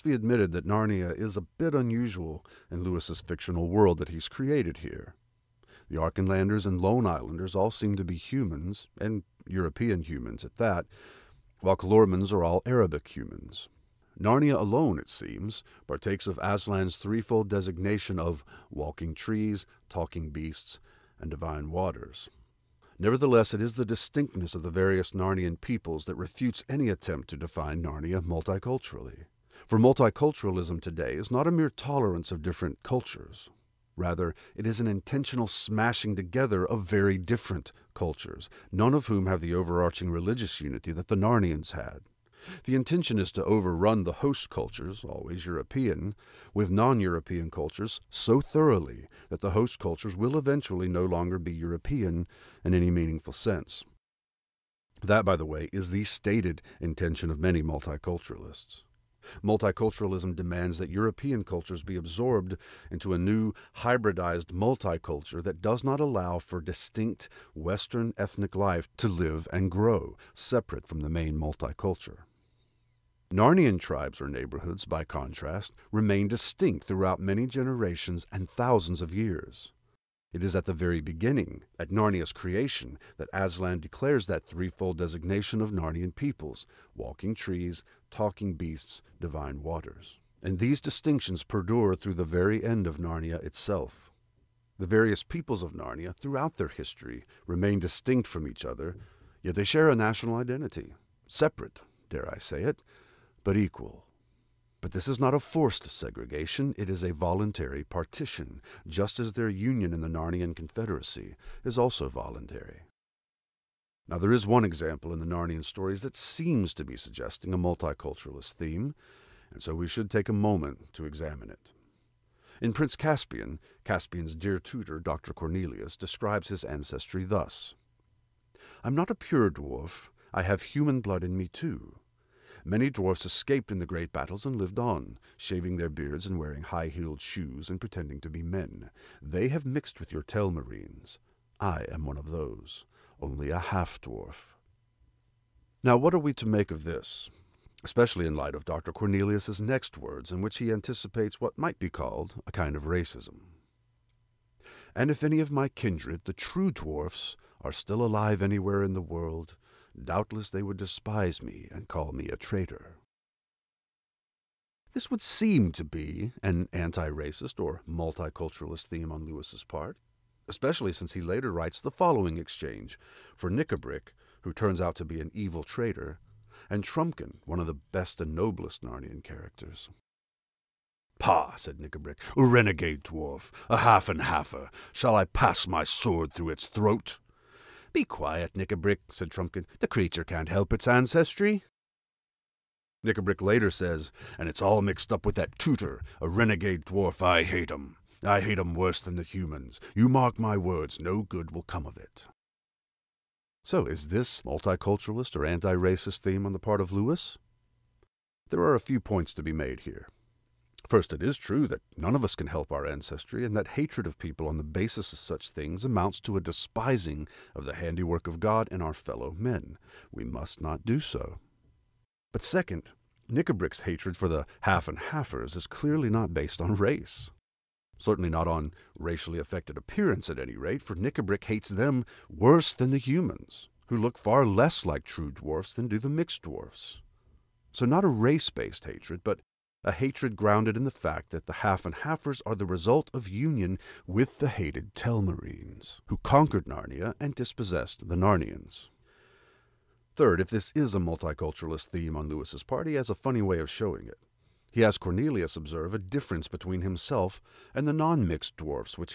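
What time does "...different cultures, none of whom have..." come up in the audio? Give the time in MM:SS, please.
00:37.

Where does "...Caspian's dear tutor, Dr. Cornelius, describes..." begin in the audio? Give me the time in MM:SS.
02:03.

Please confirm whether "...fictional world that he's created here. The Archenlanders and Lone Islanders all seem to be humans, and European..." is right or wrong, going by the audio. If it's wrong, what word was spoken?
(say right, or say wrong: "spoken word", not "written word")
right.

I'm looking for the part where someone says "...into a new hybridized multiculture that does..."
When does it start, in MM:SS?
01:02.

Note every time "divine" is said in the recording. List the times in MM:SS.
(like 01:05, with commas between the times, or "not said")
00:21, 01:29.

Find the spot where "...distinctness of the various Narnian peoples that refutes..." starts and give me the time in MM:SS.
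00:23.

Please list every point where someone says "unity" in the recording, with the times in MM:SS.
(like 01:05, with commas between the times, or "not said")
00:40.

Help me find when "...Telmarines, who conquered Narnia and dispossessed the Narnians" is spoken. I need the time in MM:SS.
04:04.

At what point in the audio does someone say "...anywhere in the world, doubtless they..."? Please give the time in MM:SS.
02:38.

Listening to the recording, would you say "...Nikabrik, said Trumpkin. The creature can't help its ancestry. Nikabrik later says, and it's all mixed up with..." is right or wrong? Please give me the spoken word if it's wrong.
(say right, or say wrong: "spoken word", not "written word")
right.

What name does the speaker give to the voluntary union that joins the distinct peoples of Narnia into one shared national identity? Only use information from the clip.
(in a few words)
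Narnian Confederacy.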